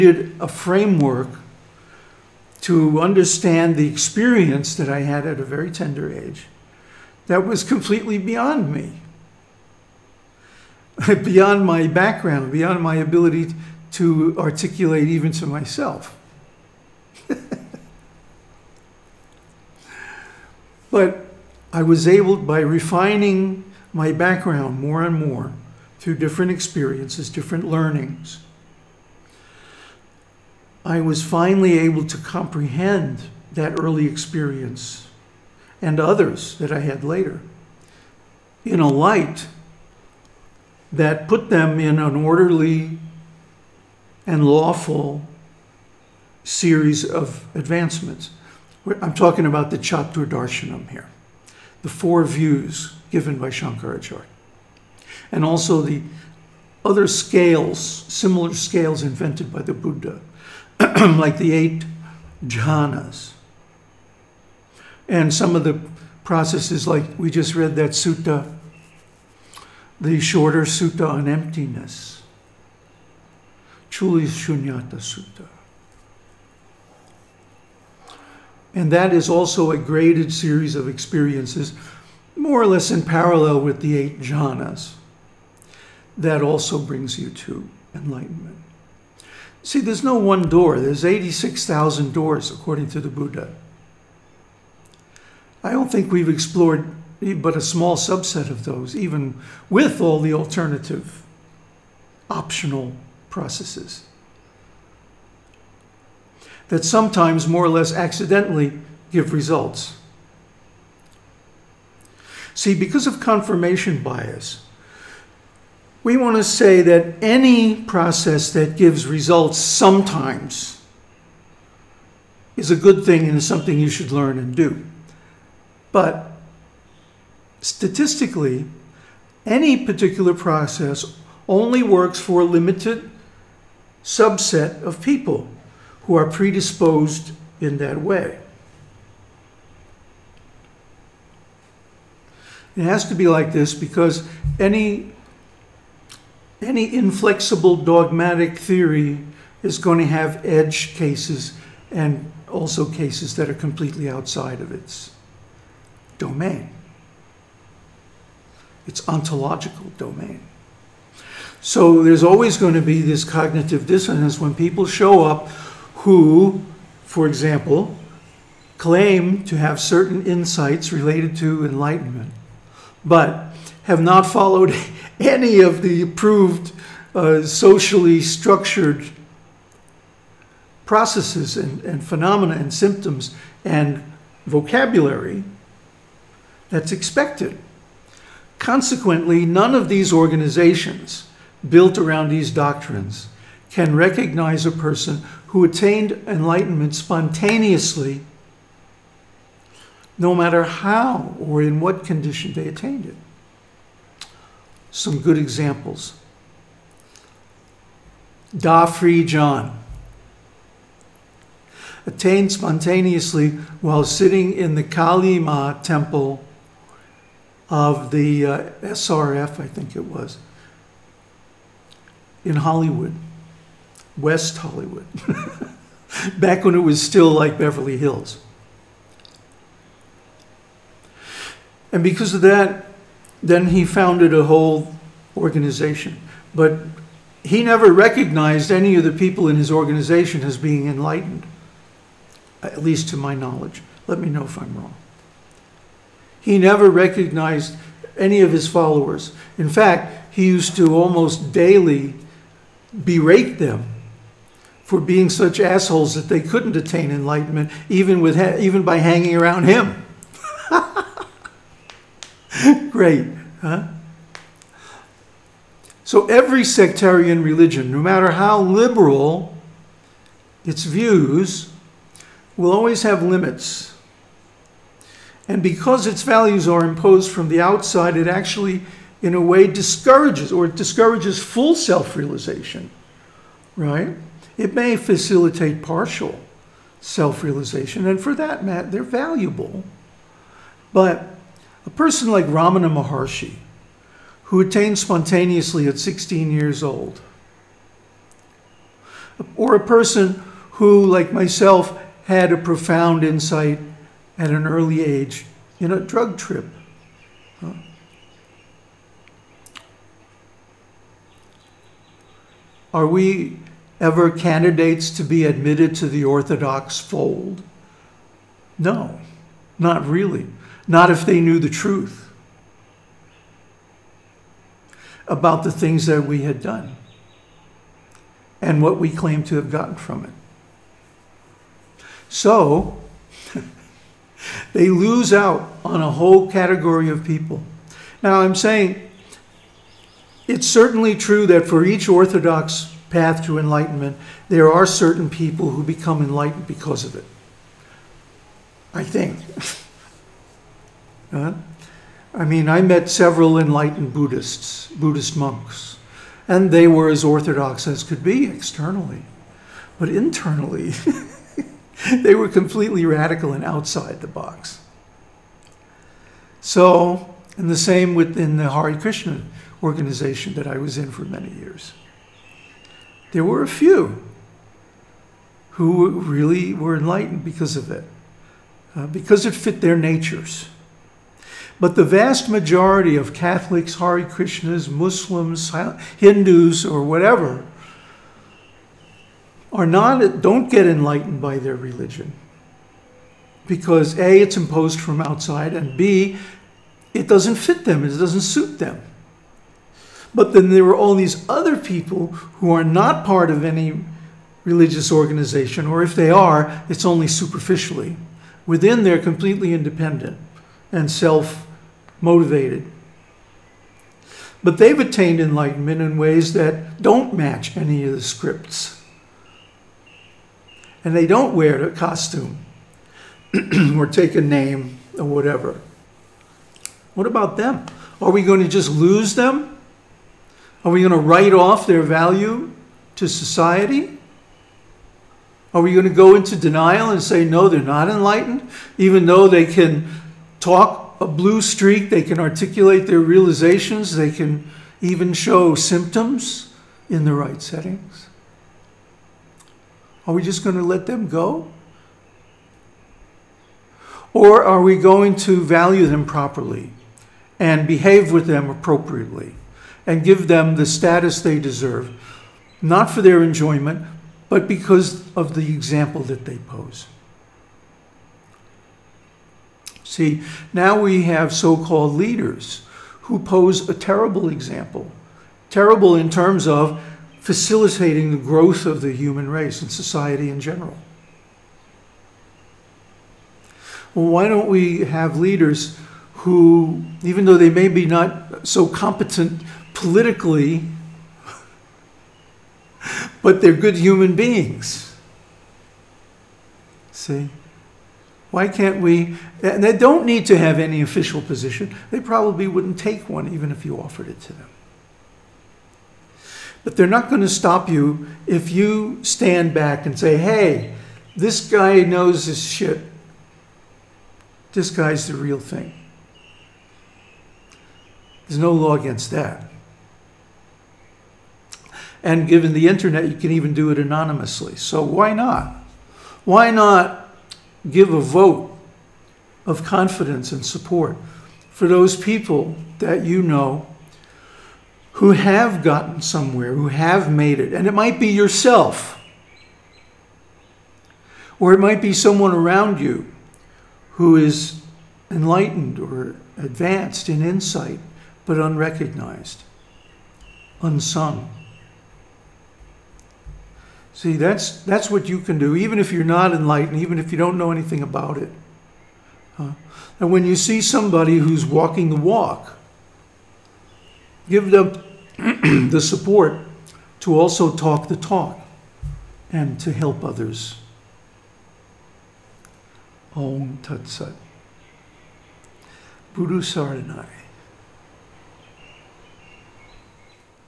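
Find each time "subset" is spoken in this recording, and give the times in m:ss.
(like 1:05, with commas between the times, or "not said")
1:37, 2:14.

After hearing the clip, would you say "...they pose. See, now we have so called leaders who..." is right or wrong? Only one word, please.
right.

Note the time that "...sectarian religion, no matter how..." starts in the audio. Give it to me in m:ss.
4:26.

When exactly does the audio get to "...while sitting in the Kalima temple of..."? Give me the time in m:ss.
3:33.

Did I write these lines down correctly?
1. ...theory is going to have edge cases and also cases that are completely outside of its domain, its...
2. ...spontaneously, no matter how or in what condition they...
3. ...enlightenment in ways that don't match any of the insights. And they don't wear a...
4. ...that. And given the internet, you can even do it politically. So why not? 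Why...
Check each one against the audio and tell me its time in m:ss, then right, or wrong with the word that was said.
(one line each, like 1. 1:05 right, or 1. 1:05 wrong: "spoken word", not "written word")
1. 2:28 right
2. 3:16 right
3. 6:55 wrong: "scripts", not "insights"
4. 8:39 wrong: "anonymously", not "politically".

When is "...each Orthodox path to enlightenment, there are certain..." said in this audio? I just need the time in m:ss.
5:41.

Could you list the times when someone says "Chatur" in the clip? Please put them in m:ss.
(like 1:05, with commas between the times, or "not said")
0:49.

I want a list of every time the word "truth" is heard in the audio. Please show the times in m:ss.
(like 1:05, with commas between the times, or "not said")
5:21.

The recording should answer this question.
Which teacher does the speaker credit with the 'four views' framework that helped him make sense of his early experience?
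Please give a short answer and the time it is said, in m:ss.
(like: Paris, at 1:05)
Shankaracharya, at 0:53.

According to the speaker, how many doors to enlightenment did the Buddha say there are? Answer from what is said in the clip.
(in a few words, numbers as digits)
86,000.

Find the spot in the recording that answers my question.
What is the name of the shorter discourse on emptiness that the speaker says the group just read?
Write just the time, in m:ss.
1:13.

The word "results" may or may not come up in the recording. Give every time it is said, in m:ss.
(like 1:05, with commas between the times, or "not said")
1:49, 1:59.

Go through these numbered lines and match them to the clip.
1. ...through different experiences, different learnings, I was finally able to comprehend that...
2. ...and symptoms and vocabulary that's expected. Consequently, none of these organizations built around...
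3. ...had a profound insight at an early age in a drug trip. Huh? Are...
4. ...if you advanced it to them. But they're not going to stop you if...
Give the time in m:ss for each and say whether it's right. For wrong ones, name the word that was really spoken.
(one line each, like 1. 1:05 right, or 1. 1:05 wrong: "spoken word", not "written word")
1. 0:25 right
2. 3:02 right
3. 5:02 right
4. 8:23 wrong: "offered", not "advanced".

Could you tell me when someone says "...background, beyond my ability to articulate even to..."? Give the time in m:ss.
0:11.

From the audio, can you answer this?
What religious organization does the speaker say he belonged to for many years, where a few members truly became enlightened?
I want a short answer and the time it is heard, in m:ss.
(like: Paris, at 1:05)
Hare Krishna, at 6:08.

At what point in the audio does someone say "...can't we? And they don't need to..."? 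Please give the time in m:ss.
8:18.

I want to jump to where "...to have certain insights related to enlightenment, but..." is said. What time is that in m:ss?
2:49.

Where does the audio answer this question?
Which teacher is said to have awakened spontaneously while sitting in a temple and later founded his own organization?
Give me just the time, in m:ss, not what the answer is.
3:28.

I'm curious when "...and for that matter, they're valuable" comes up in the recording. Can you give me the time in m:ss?
4:48.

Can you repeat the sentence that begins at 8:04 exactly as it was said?
Well, why don't we have leaders who, even though they may be not so competent politically, but they're good human beings.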